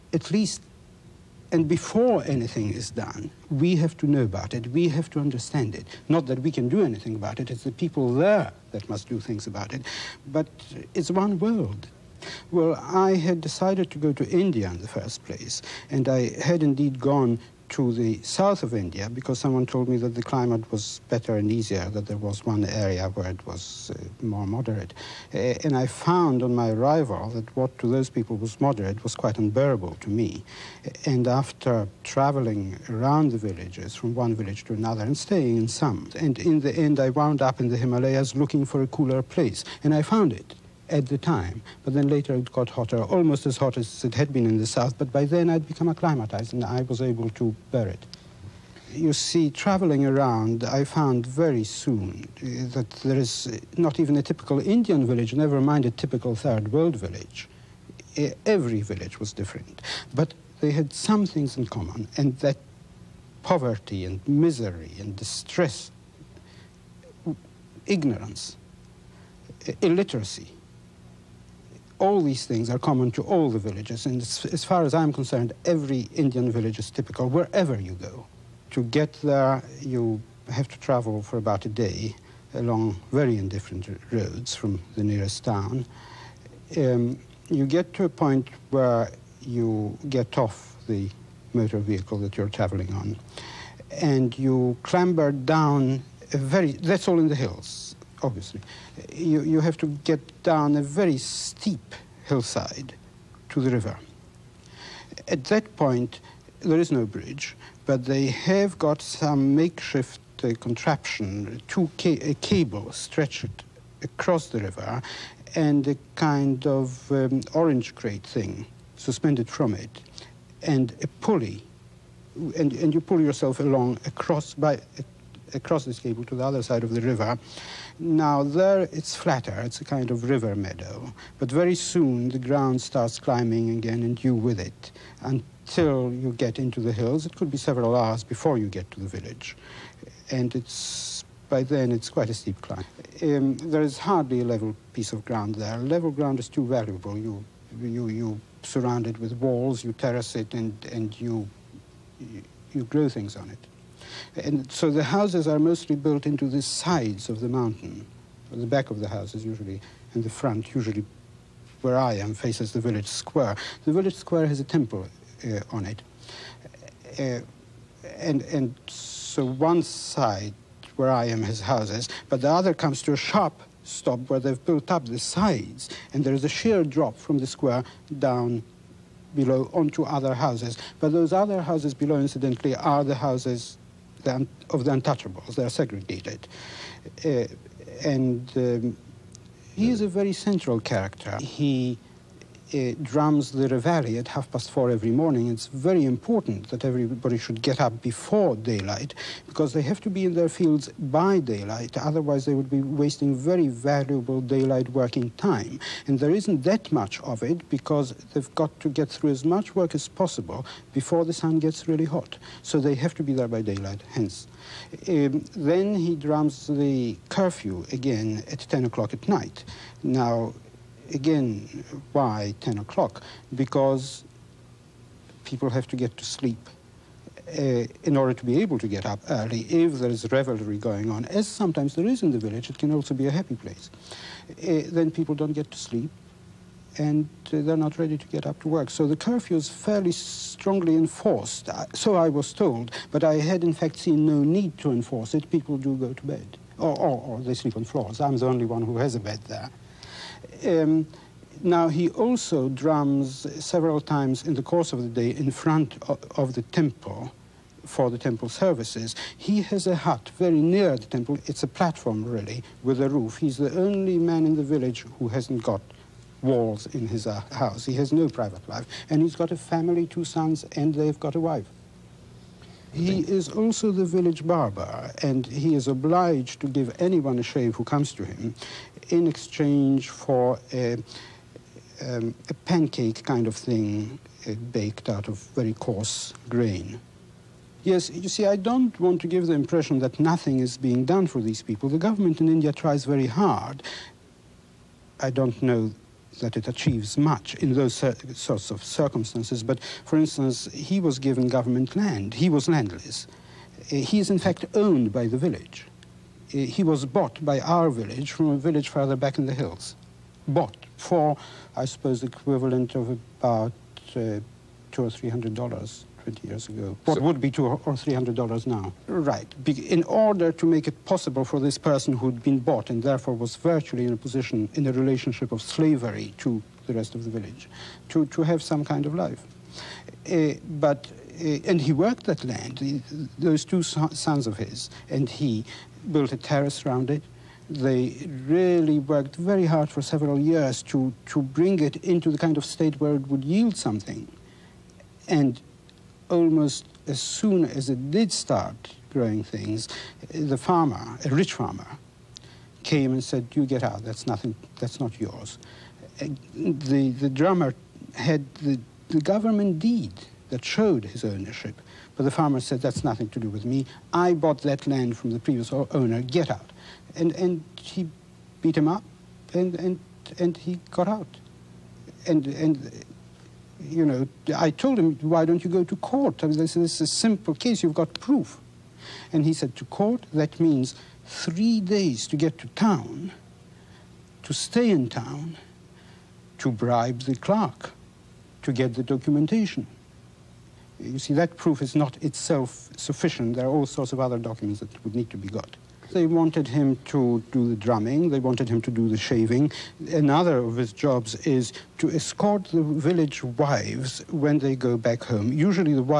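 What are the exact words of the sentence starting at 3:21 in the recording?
Otherwise, they would be wasting very valuable daylight working time.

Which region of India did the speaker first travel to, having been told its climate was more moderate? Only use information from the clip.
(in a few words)
The south of India.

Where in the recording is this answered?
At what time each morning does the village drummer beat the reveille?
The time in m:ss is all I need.
3:14.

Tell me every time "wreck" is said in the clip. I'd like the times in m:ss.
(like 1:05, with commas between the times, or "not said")
not said.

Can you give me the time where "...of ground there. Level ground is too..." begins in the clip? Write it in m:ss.
2:25.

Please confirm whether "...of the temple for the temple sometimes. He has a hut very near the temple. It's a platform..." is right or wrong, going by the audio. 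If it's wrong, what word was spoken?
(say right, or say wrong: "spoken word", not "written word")
wrong: "services", not "sometimes".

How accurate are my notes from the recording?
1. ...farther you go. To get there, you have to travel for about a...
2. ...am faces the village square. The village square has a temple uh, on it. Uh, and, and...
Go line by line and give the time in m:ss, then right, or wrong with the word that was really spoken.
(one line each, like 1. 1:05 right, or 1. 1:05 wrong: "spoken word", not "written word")
1. 1:17 wrong: "wherever", not "farther"
2. 2:42 right.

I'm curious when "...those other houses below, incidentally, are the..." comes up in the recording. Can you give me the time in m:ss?
3:01.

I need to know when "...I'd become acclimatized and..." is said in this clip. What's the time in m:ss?
0:45.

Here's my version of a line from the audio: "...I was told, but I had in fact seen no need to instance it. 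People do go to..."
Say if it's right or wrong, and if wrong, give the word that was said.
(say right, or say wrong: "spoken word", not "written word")
wrong: "enforce", not "instance".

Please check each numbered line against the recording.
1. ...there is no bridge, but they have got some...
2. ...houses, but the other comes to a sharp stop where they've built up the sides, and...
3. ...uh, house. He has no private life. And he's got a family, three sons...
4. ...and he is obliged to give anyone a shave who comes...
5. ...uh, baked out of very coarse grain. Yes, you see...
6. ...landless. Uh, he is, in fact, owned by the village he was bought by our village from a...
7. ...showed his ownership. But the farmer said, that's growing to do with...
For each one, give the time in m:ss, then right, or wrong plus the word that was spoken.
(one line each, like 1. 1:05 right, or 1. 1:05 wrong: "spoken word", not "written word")
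1. 1:46 right
2. 2:51 right
3. 4:27 wrong: "two", not "three"
4. 4:35 right
5. 4:44 right
6. 5:02 right
7. 6:00 wrong: "nothing", not "growing".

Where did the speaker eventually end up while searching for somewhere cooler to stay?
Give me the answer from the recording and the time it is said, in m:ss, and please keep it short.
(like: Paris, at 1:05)
The Himalayas, at 0:37.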